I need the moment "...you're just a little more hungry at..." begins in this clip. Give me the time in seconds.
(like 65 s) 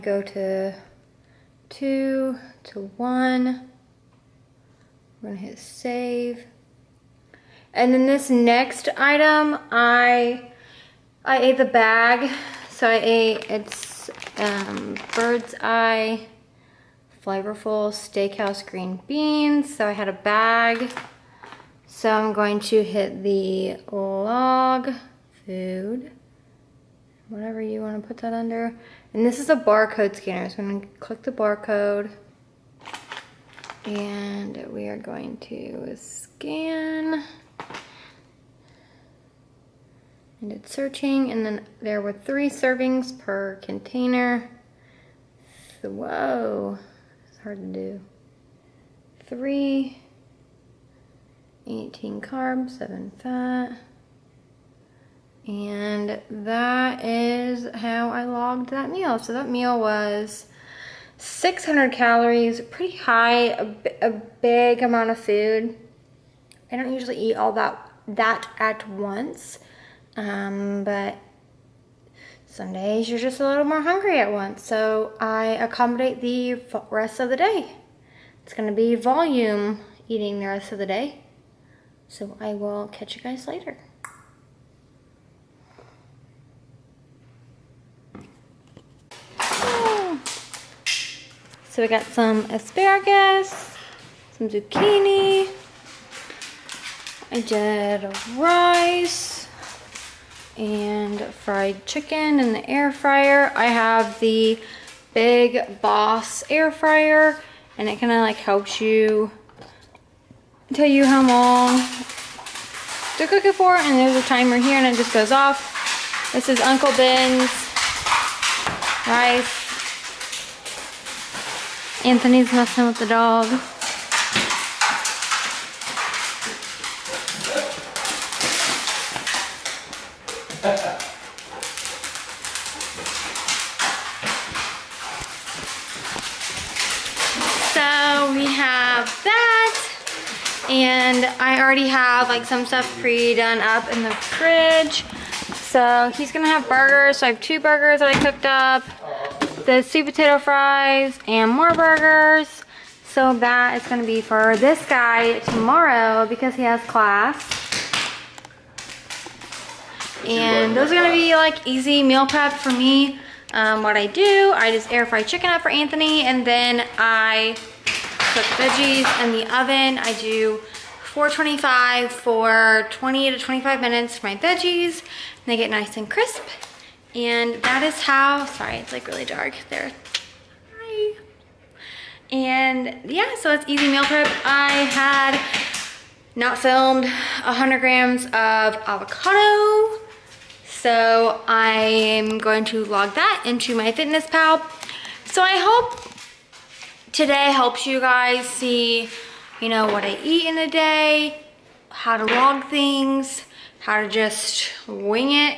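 73 s.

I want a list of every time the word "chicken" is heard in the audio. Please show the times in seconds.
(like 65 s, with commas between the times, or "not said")
101 s, 165 s.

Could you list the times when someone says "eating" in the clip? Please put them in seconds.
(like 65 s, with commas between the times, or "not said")
80 s.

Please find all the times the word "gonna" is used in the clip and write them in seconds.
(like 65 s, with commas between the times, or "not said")
5 s, 78 s, 146 s.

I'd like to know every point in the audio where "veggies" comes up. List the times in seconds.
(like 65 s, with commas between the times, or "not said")
168 s, 174 s.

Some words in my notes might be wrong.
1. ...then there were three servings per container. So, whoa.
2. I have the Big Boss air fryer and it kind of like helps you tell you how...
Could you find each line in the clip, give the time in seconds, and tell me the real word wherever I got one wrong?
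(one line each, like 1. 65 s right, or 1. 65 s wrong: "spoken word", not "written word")
1. 41 s right
2. 103 s right.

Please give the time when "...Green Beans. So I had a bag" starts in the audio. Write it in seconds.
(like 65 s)
18 s.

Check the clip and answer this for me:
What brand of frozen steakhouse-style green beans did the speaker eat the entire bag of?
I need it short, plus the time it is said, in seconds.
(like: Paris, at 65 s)
Bird's Eye, at 15 s.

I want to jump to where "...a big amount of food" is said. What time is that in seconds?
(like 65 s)
64 s.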